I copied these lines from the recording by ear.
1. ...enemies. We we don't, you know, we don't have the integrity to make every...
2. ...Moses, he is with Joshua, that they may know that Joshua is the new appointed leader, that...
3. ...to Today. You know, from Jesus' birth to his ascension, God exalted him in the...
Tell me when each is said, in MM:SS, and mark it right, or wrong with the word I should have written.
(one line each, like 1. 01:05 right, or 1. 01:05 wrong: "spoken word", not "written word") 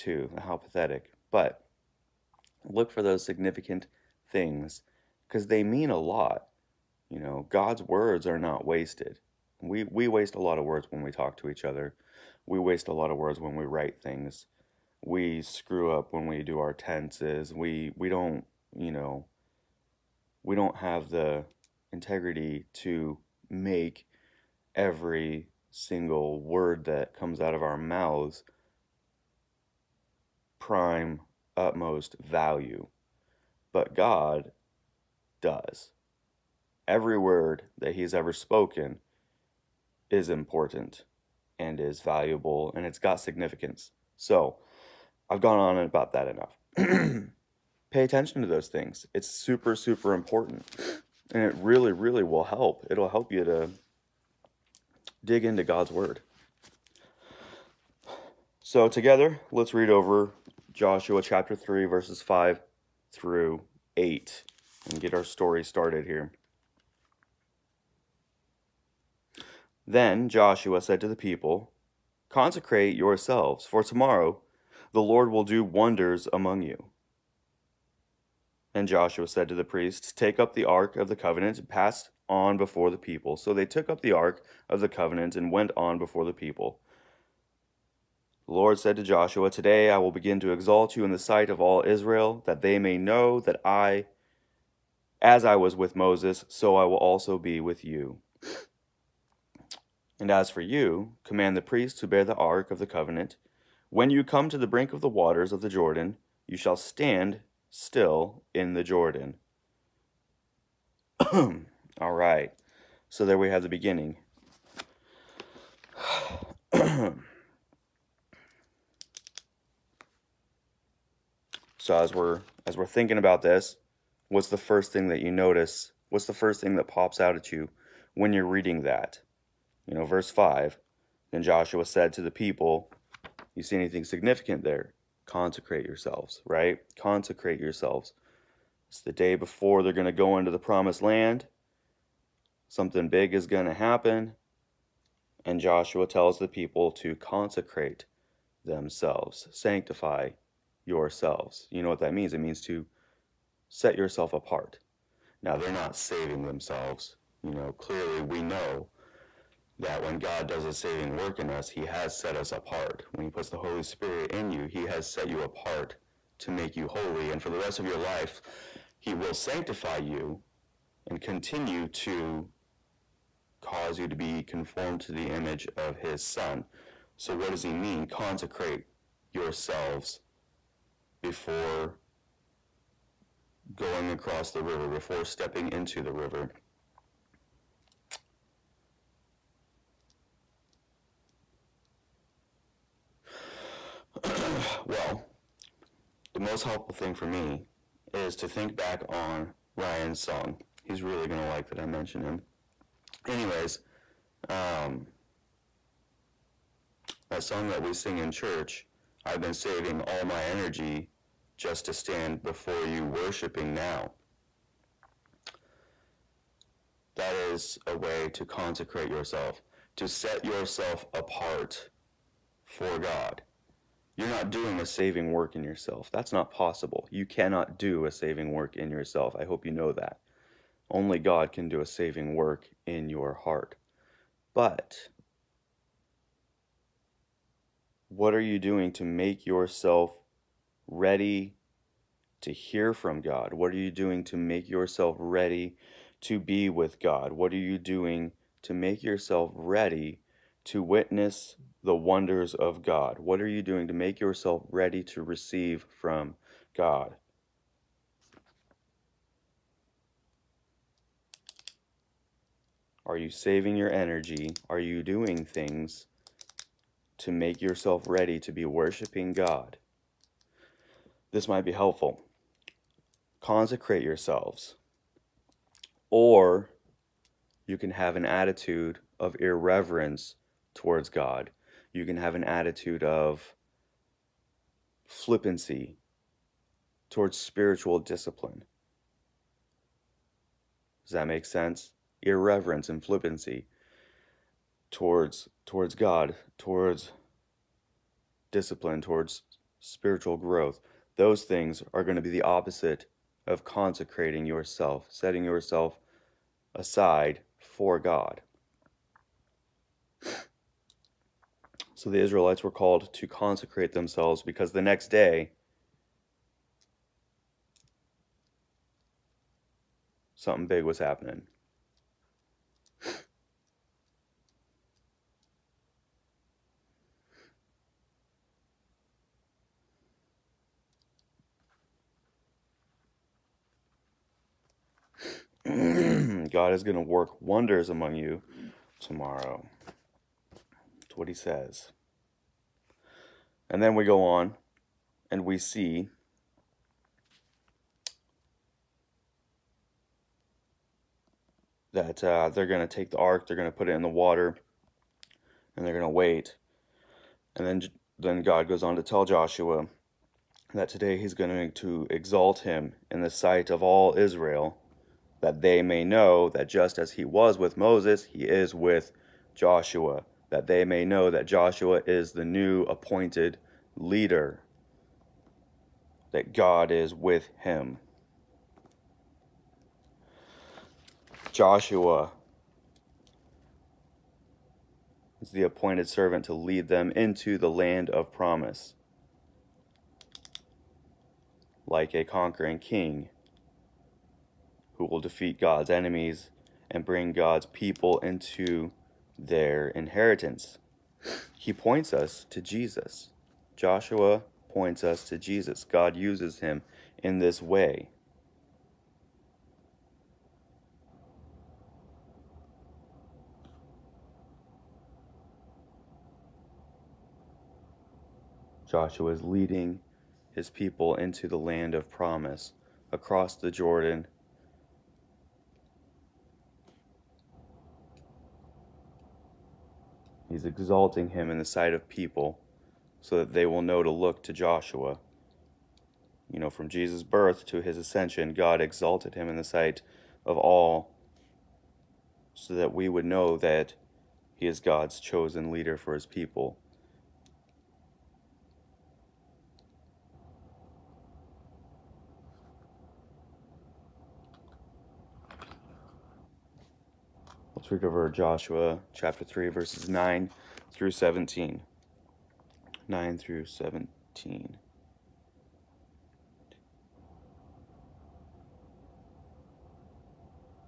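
1. 00:16 wrong: "tenses", not "enemies"
2. 06:07 right
3. 07:14 wrong: "Joshua", not "Today".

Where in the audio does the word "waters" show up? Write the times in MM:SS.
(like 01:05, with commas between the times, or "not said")
01:45, 05:54.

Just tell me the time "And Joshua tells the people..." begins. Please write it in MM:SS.
02:25.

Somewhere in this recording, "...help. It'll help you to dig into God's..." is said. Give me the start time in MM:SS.
00:52.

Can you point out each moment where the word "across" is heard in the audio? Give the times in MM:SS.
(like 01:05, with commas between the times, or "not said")
03:04, 07:03.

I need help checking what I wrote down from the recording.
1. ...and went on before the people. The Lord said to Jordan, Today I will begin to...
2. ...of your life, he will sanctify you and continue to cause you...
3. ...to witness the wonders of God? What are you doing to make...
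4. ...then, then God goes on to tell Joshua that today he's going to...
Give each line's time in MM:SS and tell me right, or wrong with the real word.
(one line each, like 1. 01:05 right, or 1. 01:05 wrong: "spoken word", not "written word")
1. 01:25 wrong: "Joshua", not "Jordan"
2. 02:47 right
3. 04:10 right
4. 05:57 right.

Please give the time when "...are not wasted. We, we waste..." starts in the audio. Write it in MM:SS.
00:08.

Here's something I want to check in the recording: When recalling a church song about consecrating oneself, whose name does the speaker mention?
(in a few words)
Ryan.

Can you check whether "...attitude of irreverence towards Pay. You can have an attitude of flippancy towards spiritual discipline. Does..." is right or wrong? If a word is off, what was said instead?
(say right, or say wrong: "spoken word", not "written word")
wrong: "God", not "Pay".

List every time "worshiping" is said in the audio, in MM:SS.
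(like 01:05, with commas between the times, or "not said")
03:33, 04:28.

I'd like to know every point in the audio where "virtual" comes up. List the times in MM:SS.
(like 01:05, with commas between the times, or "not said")
not said.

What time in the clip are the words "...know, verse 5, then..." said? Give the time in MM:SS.
02:09.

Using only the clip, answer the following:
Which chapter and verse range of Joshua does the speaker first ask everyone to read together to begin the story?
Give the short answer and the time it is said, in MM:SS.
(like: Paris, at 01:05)
Chapter 3, verses 5-8, at 01:00.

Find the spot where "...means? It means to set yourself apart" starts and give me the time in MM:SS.
02:32.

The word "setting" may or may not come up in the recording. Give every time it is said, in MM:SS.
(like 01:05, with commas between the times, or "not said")
05:05.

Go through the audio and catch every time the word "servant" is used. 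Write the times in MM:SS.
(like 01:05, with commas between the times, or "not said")
06:26.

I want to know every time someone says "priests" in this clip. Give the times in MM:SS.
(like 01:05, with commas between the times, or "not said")
01:19, 01:41.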